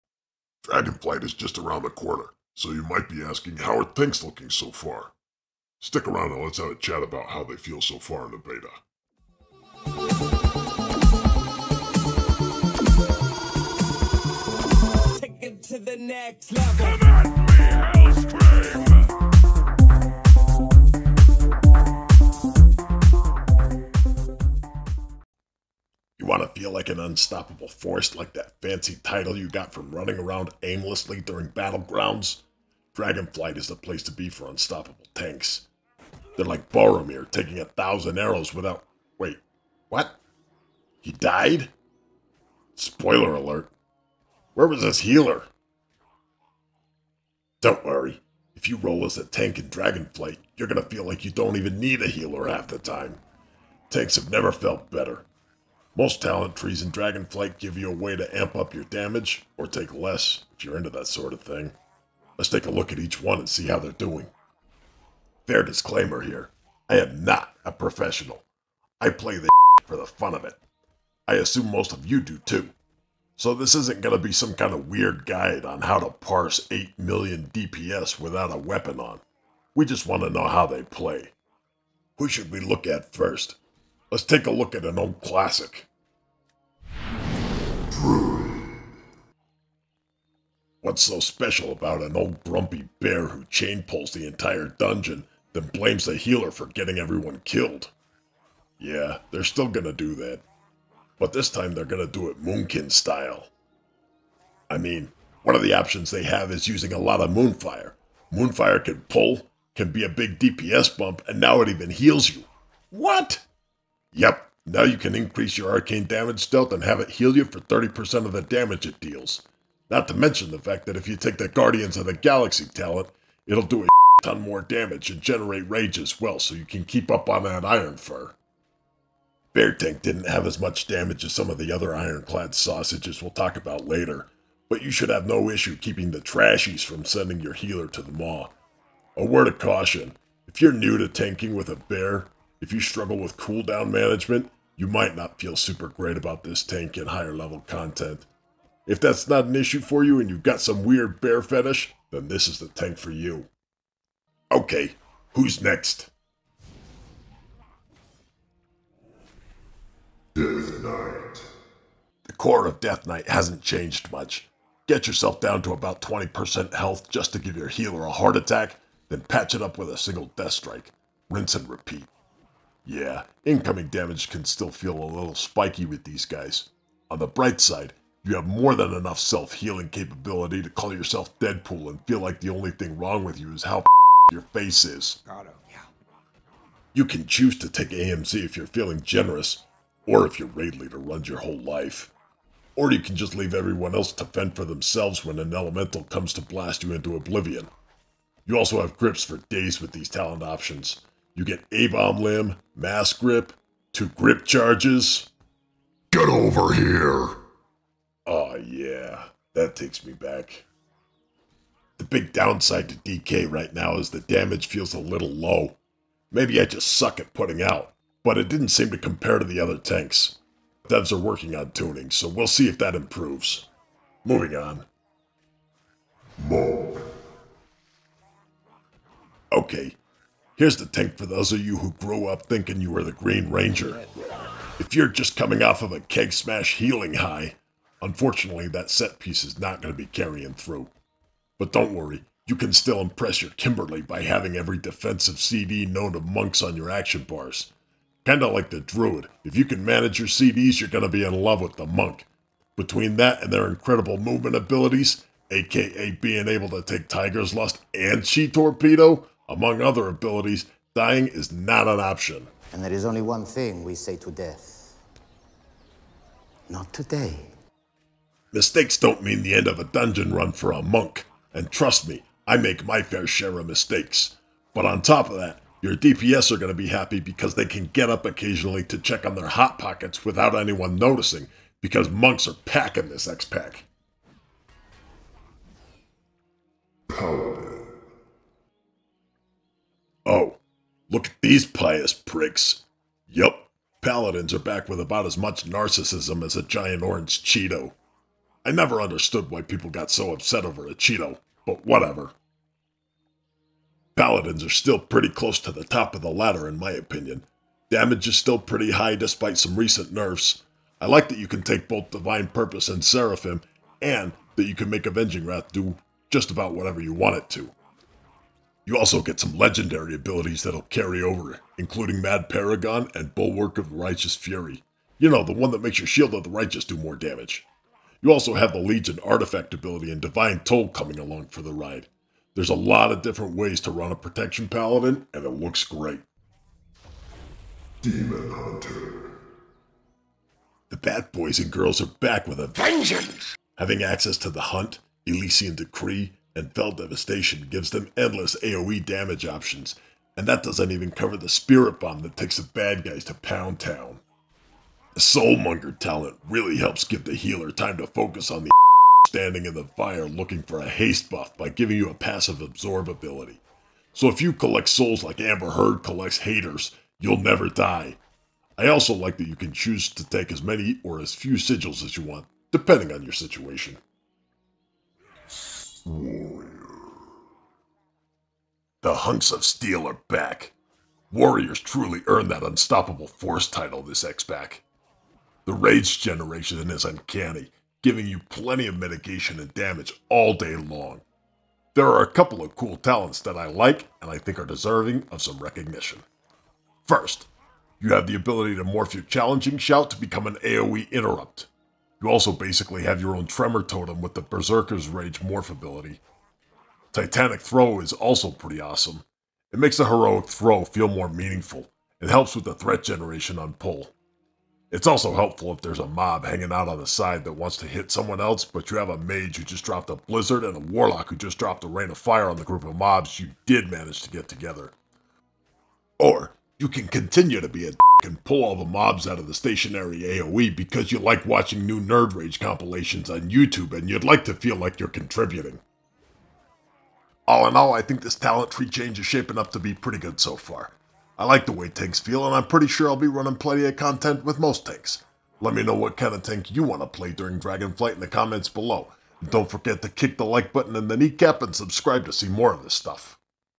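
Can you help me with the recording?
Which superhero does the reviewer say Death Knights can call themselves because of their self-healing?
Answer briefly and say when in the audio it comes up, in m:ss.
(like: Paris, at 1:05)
Deadpool, at 3:01.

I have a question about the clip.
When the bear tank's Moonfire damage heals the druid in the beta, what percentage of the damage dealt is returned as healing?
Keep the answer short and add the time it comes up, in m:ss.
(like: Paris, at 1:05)
30%, at 1:57.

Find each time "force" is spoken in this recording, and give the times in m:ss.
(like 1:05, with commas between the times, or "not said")
0:27, 6:23.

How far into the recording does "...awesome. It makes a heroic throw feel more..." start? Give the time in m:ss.
6:48.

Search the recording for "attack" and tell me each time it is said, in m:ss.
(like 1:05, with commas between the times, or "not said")
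2:48.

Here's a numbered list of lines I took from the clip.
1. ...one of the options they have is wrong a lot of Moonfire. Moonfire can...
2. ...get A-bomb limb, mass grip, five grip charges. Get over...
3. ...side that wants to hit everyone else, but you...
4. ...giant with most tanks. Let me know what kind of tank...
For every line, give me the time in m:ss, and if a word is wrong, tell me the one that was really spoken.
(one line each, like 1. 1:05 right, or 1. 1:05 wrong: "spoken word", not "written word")
1. 1:45 wrong: "using", not "wrong"
2. 3:21 wrong: "two", not "five"
3. 6:57 wrong: "someone", not "everyone"
4. 7:23 wrong: "content", not "giant".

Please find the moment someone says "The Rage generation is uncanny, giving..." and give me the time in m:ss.
6:25.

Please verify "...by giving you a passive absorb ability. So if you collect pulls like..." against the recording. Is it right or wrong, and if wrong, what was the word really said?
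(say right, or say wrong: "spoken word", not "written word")
wrong: "souls", not "pulls".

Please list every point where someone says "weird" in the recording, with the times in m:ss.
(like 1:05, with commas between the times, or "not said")
1:14, 2:30.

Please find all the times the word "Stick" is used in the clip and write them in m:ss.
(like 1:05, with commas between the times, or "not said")
0:05.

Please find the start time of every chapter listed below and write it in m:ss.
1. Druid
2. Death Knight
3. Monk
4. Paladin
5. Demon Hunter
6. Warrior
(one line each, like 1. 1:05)
1. 1:25
2. 2:35
3. 3:45
4. 4:44
5. 5:35
6. 6:14.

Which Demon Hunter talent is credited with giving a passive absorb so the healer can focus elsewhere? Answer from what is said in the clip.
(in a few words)
Soulmonger.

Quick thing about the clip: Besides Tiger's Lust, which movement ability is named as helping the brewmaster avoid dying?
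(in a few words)
Chi Torpedo.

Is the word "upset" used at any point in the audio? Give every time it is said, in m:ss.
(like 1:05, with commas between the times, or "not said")
5:00.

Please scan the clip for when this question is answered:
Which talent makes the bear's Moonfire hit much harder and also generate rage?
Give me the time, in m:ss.
2:01.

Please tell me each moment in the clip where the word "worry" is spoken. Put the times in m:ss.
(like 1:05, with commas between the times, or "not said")
0:47, 4:01.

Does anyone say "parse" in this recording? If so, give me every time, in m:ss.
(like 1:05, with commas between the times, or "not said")
1:16.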